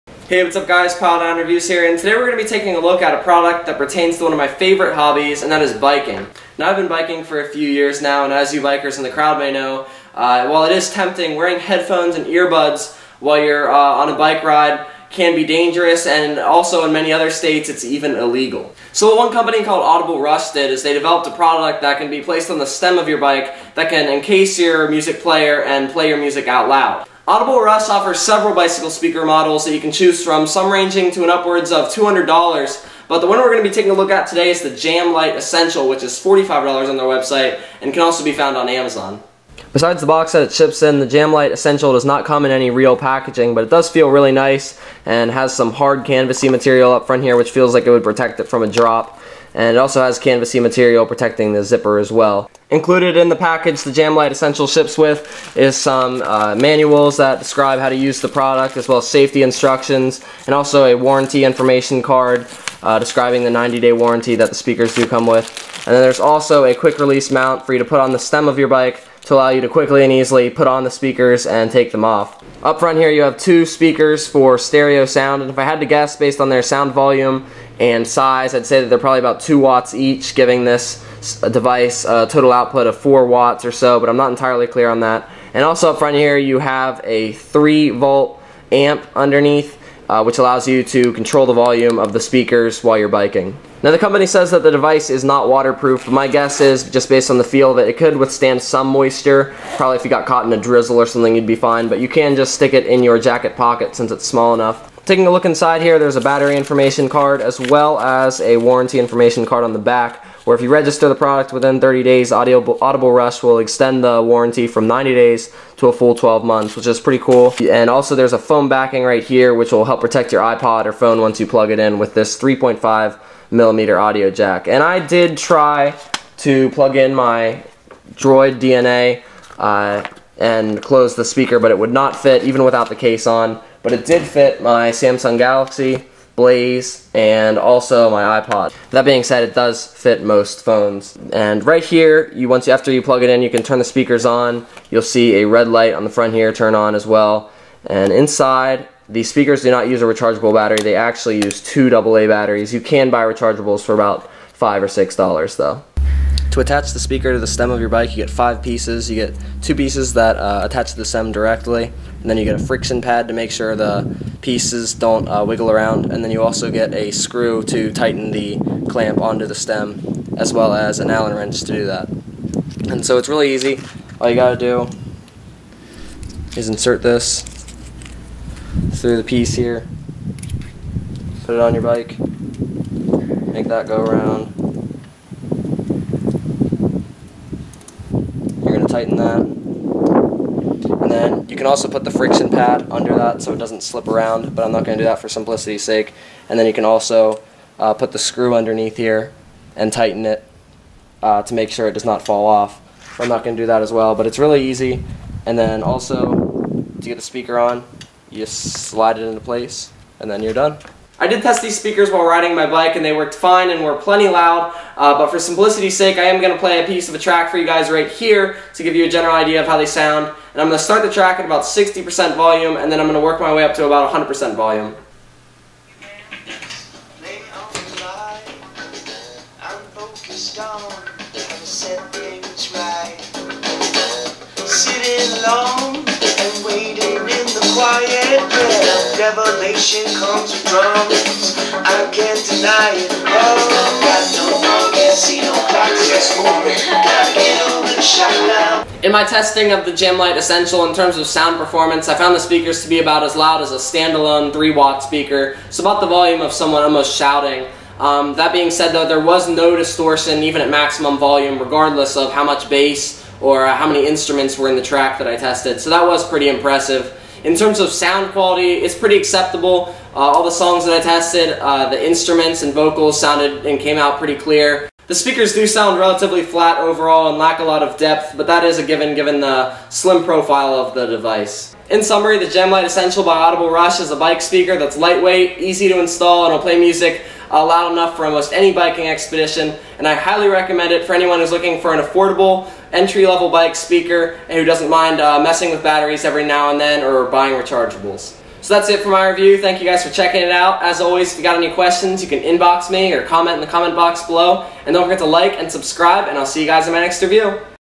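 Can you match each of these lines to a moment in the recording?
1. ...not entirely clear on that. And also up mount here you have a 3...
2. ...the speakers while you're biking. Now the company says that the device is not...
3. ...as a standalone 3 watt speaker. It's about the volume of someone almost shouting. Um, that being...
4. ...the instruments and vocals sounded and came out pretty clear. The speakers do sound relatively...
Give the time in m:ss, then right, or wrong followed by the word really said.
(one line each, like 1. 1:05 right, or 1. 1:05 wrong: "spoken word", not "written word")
1. 1:24 wrong: "front", not "mount"
2. 1:32 right
3. 4:13 right
4. 4:31 right.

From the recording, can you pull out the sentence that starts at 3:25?
And then also, to get the speaker on, you just slide it into place, and then you're done.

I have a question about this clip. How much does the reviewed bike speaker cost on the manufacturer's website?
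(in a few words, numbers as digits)
$45.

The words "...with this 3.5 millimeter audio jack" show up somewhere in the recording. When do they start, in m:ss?
2:01.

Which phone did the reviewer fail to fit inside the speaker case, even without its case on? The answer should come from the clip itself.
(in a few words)
Droid DNA.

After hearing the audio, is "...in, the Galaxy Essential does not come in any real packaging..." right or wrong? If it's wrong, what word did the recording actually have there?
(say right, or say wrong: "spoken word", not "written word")
wrong: "JamLite", not "Galaxy".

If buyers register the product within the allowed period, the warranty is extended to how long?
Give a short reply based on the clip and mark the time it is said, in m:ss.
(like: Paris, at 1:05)
12 months, at 1:56.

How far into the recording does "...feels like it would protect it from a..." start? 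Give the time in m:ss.
0:47.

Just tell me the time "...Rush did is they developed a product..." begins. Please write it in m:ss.
0:20.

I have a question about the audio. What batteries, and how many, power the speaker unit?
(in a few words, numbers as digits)
Two AA batteries.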